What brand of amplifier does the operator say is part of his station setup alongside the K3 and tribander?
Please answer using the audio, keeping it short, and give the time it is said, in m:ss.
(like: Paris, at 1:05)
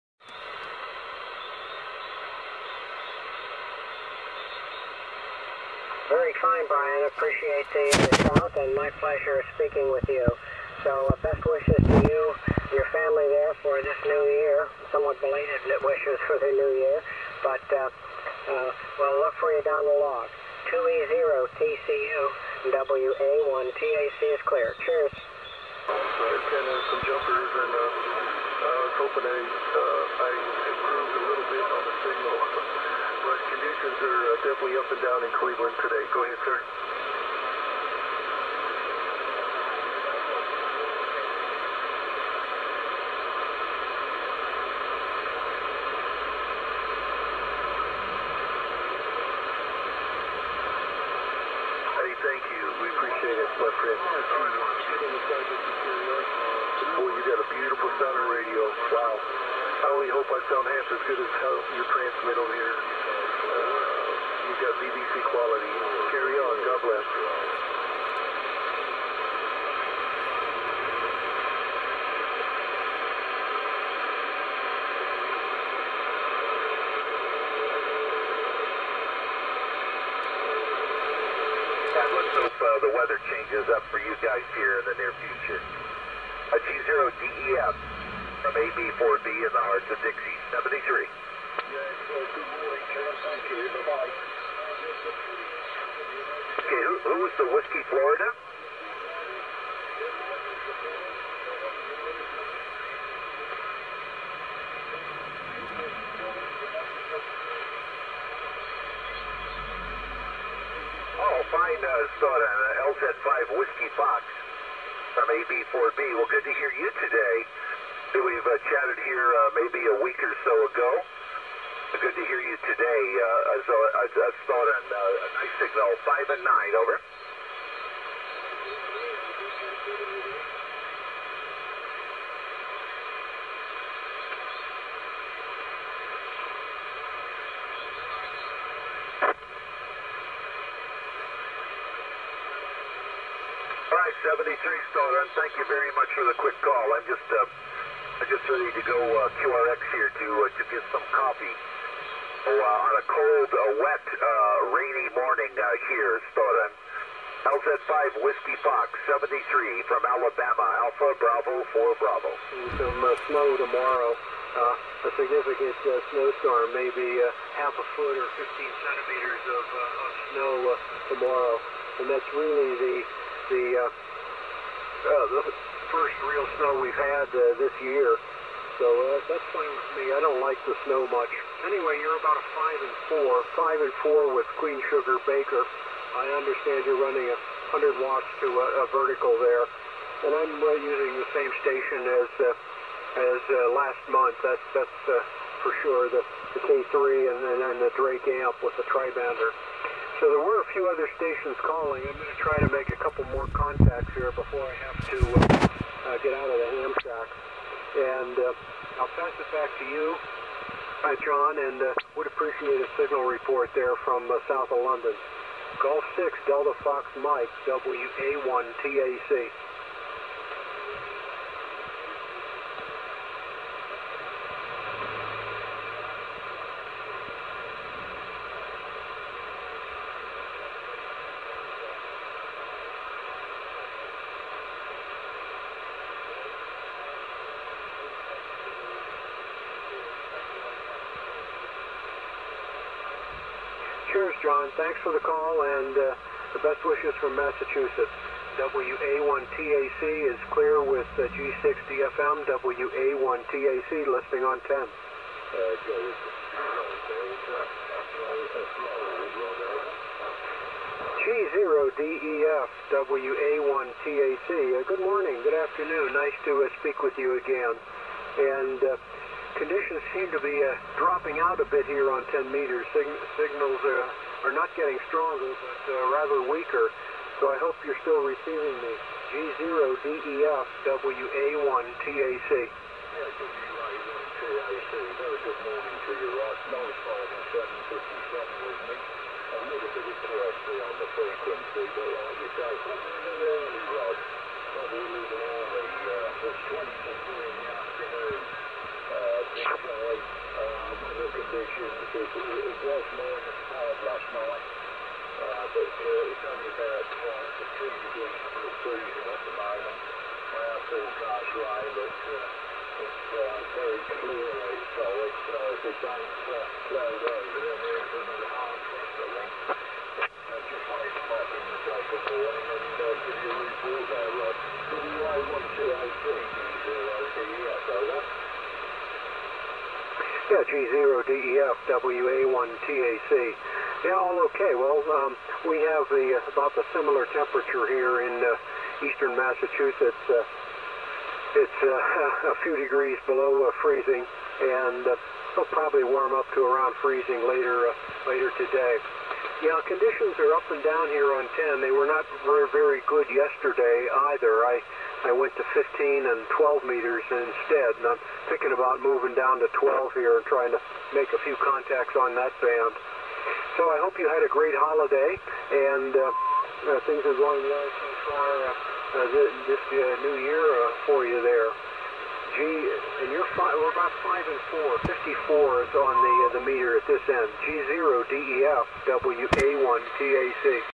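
Drake, at 3:17.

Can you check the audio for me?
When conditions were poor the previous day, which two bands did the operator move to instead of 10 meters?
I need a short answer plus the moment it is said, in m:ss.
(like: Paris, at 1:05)
15 and 12 meters, at 5:55.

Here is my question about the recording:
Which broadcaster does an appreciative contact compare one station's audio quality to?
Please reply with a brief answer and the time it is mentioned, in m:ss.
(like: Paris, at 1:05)
BBC, at 1:04.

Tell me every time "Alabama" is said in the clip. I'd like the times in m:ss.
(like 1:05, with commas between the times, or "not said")
2:40.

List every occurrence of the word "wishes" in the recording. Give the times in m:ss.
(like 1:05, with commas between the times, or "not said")
0:11, 0:15, 4:06.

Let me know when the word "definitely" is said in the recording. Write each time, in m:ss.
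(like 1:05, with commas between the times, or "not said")
0:34.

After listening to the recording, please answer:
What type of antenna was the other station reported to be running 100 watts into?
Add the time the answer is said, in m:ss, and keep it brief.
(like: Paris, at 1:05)
a vertical, at 3:08.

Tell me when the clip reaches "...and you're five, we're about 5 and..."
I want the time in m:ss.
6:13.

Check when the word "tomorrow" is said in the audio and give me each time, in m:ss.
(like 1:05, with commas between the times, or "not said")
2:43, 2:51.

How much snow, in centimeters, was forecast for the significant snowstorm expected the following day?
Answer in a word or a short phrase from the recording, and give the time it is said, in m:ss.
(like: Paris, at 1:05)
15, at 2:48.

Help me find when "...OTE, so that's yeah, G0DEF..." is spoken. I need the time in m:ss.
5:27.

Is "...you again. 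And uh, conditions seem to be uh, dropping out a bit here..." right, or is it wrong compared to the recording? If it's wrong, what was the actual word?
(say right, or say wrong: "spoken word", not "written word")
right.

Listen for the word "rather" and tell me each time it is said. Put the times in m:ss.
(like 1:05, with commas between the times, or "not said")
4:36.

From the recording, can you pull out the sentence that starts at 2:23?
All right, 73 Stoner, thank you very much for the quick call.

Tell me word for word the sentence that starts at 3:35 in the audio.
Gulf 6, Delta Fox Mike, WA1 TAC.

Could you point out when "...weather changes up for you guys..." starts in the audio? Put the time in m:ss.
1:22.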